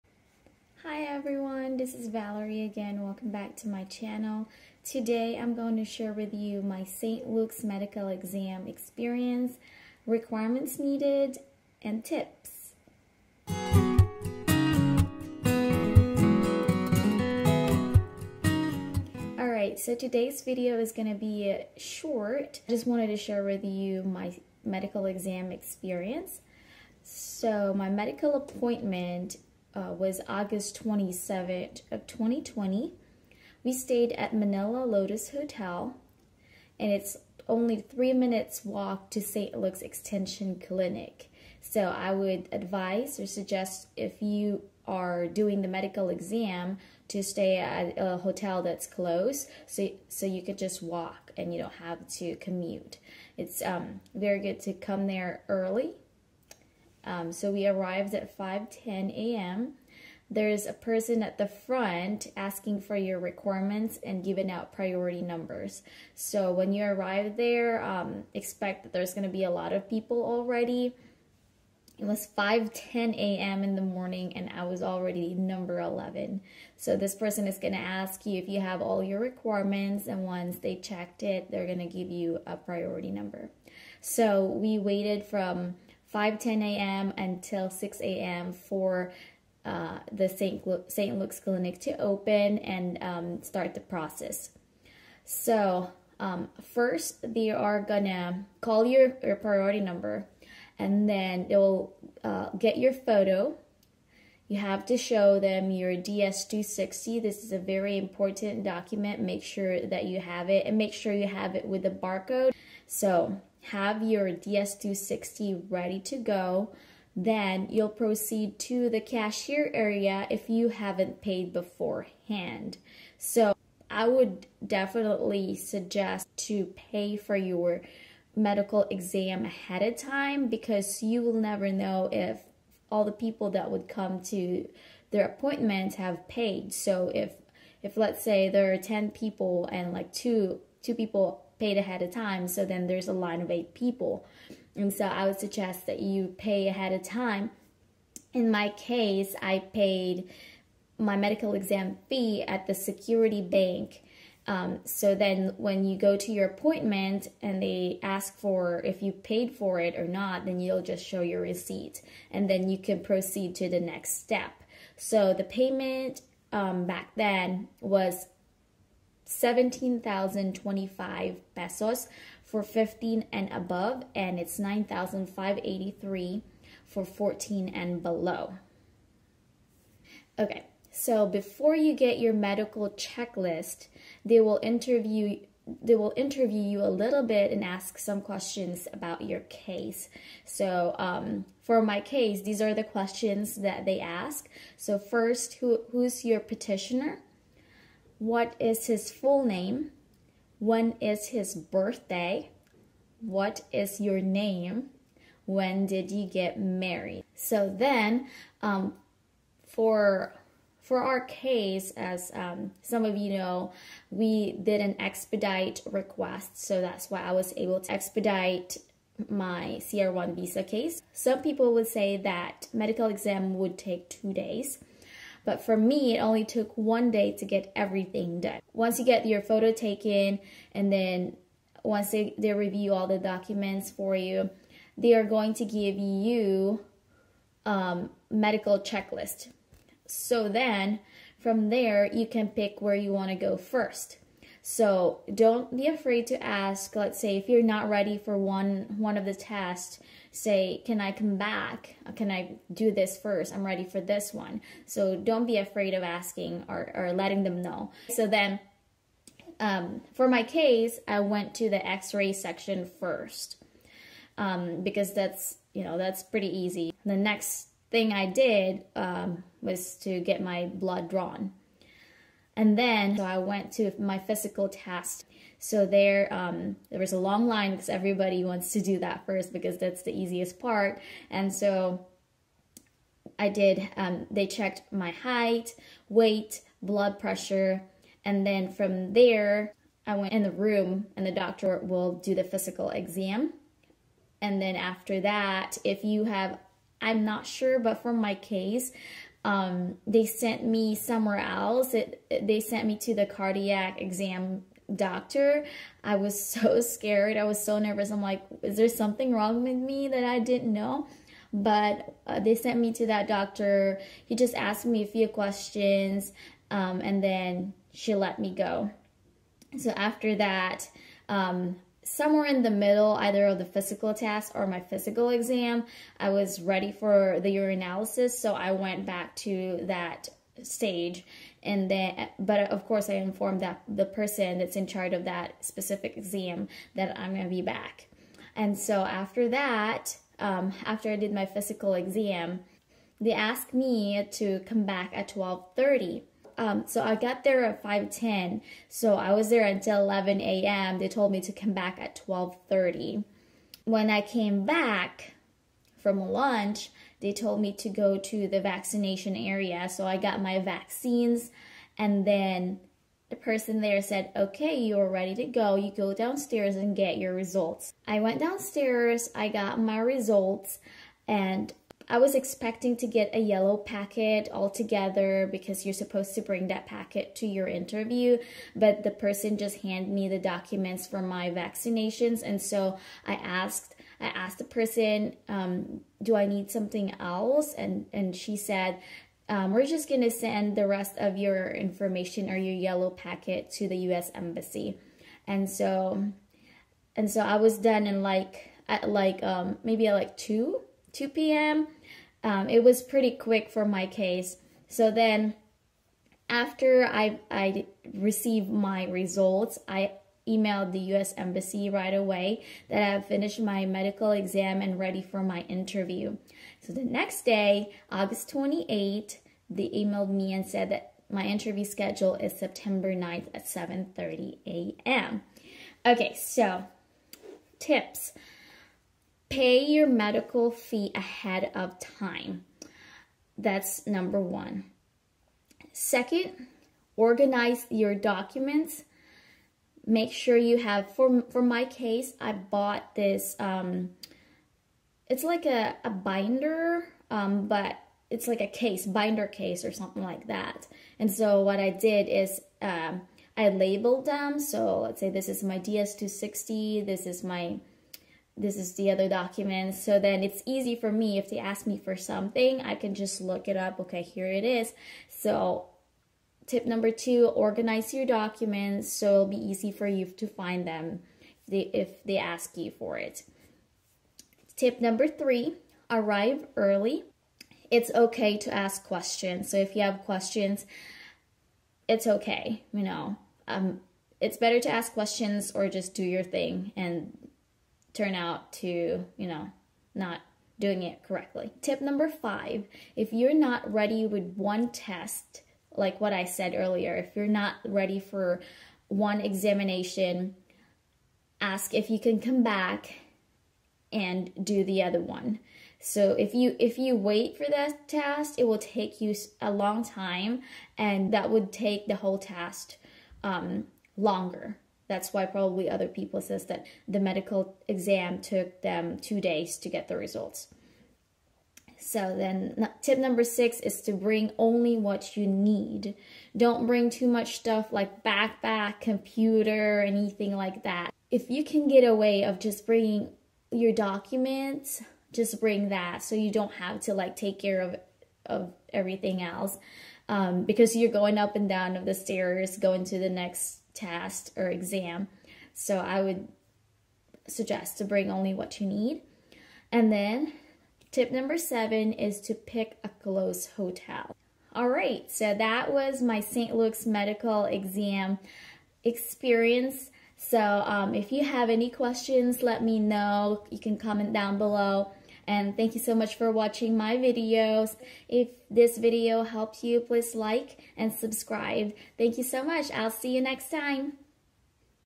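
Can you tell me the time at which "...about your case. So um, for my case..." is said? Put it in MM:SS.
03:08.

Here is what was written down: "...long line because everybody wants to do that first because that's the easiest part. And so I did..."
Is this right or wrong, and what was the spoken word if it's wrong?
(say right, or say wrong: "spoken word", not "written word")
right.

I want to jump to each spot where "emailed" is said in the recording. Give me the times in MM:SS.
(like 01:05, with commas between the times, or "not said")
06:50, 06:59.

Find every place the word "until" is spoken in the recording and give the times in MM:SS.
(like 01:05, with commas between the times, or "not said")
01:27, 05:49.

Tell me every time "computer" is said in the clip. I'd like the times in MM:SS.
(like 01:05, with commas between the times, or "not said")
08:49.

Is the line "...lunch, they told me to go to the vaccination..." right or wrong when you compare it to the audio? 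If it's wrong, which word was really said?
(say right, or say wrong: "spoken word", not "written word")
right.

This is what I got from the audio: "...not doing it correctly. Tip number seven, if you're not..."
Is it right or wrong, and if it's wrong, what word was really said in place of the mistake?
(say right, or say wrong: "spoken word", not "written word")
wrong: "five", not "seven".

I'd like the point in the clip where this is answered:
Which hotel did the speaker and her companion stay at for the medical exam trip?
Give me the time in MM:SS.
00:34.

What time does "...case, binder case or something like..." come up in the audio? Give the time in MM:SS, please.
07:28.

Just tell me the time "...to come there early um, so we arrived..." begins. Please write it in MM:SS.
00:54.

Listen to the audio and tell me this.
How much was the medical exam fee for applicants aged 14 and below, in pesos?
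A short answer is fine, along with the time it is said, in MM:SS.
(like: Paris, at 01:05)
9,583 pesos, at 02:54.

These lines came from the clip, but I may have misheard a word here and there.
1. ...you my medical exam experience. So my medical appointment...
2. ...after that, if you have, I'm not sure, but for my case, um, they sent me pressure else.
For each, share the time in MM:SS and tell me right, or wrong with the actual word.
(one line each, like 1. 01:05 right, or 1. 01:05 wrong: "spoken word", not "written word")
1. 00:23 right
2. 04:54 wrong: "somewhere", not "pressure".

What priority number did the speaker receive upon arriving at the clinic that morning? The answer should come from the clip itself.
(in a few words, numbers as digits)
11.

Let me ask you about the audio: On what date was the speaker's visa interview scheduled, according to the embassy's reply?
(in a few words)
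September 9.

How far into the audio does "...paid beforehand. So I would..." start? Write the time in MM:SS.
02:01.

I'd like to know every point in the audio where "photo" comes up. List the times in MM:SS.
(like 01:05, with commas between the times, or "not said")
01:42, 03:49.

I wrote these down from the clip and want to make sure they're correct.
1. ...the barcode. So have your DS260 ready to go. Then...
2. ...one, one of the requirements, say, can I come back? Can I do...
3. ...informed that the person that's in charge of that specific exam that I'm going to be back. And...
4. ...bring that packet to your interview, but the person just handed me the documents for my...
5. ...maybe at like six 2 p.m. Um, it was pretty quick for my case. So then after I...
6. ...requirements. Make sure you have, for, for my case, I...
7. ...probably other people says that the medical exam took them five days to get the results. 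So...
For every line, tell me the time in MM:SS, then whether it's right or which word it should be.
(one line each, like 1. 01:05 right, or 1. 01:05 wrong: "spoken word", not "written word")
1. 01:51 right
2. 04:08 wrong: "tests", not "requirements"
3. 05:33 right
4. 06:16 right
5. 06:39 wrong: "two", not "six"
6. 07:18 wrong: "documents", not "requirements"
7. 08:35 wrong: "two", not "five".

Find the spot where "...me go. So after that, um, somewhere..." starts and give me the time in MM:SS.
05:18.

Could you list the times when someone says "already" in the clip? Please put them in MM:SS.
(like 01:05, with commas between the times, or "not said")
01:10, 01:14.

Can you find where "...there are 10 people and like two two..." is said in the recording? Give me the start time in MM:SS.
02:18.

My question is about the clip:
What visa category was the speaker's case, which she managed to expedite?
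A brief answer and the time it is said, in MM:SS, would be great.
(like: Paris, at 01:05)
CR1, at 03:39.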